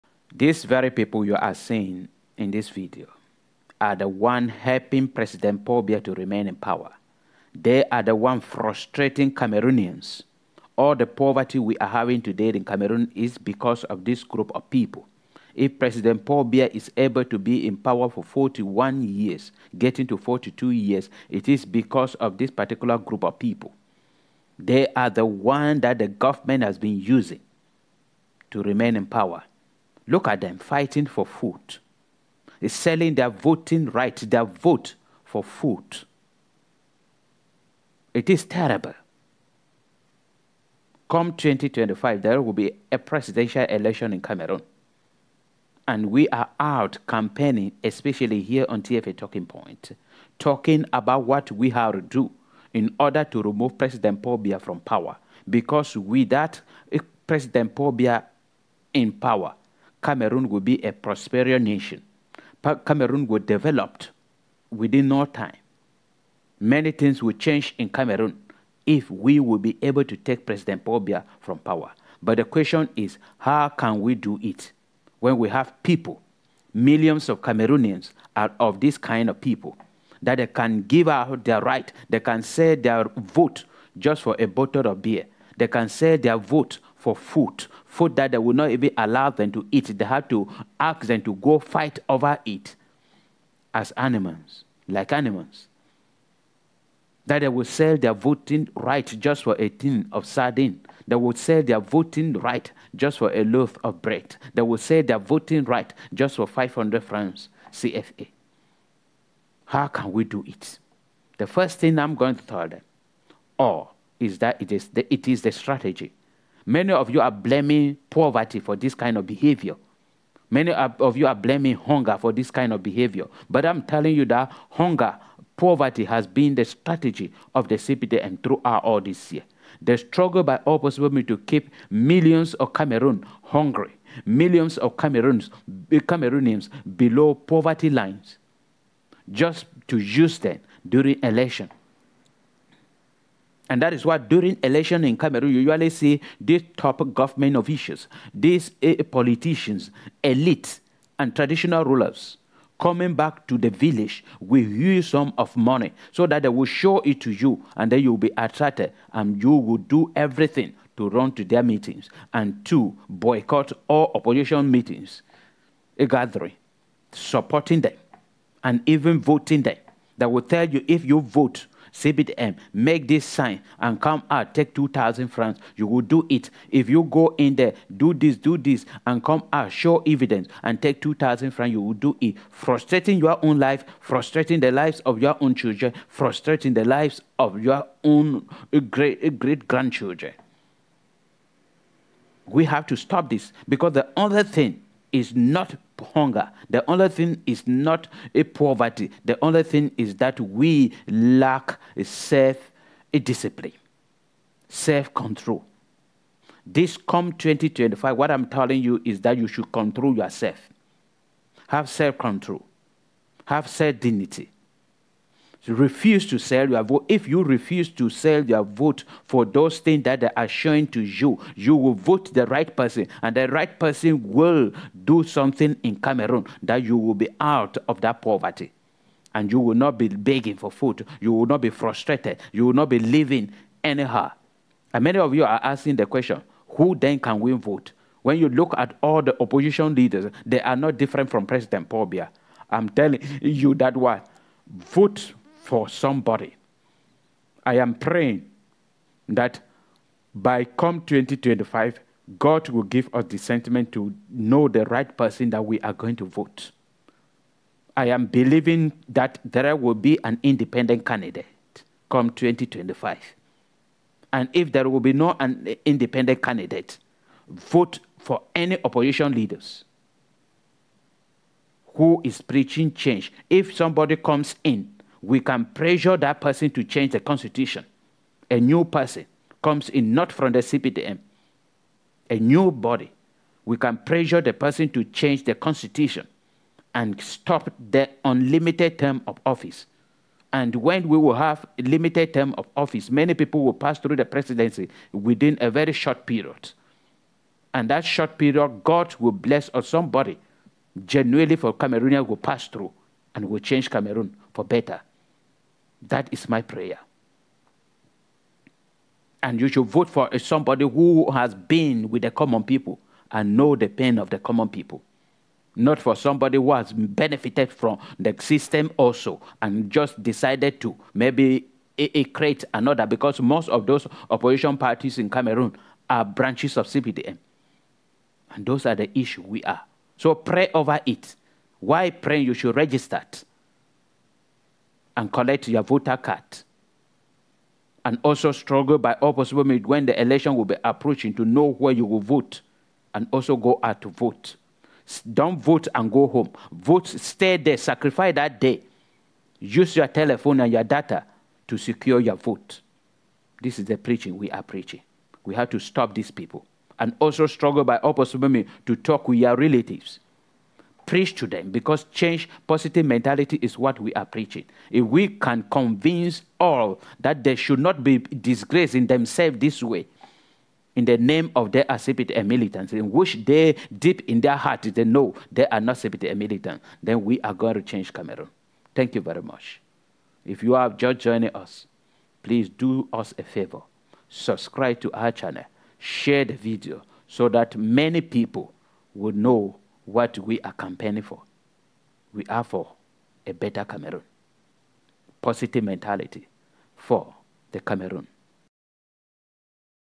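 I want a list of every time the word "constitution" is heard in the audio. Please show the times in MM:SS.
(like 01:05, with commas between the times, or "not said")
04:37, 04:45.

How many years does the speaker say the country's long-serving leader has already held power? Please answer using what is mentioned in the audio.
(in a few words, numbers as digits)
41.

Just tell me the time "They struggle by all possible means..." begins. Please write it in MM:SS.
02:09.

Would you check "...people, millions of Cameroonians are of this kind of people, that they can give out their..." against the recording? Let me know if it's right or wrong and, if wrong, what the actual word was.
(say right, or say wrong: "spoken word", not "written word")
right.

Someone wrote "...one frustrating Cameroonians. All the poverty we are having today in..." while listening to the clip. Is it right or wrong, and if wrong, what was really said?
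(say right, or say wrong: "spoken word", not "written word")
right.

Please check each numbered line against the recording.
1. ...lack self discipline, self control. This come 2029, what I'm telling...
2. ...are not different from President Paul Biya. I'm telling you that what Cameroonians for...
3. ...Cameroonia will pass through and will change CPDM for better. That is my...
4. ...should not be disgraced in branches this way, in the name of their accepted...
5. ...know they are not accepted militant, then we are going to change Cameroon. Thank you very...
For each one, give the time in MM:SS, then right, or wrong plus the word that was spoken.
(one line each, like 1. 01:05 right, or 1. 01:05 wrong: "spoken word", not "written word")
1. 03:21 wrong: "2025", not "2029"
2. 04:00 wrong: "Vote", not "Cameroonians"
3. 05:01 wrong: "Cameroon", not "CPDM"
4. 06:07 wrong: "themselves", not "branches"
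5. 06:15 right.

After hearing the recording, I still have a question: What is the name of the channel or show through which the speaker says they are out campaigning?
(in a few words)
TFA Talking Point.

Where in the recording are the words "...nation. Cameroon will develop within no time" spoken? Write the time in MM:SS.
01:01.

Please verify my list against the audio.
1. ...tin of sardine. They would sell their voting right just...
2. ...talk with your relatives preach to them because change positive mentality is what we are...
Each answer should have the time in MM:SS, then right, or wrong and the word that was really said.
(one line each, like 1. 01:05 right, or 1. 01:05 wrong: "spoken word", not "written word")
1. 01:39 right
2. 05:58 right.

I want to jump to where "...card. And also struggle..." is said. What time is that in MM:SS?
05:36.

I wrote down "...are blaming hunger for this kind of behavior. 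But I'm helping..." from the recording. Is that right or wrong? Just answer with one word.
wrong.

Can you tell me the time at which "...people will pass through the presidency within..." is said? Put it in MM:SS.
04:53.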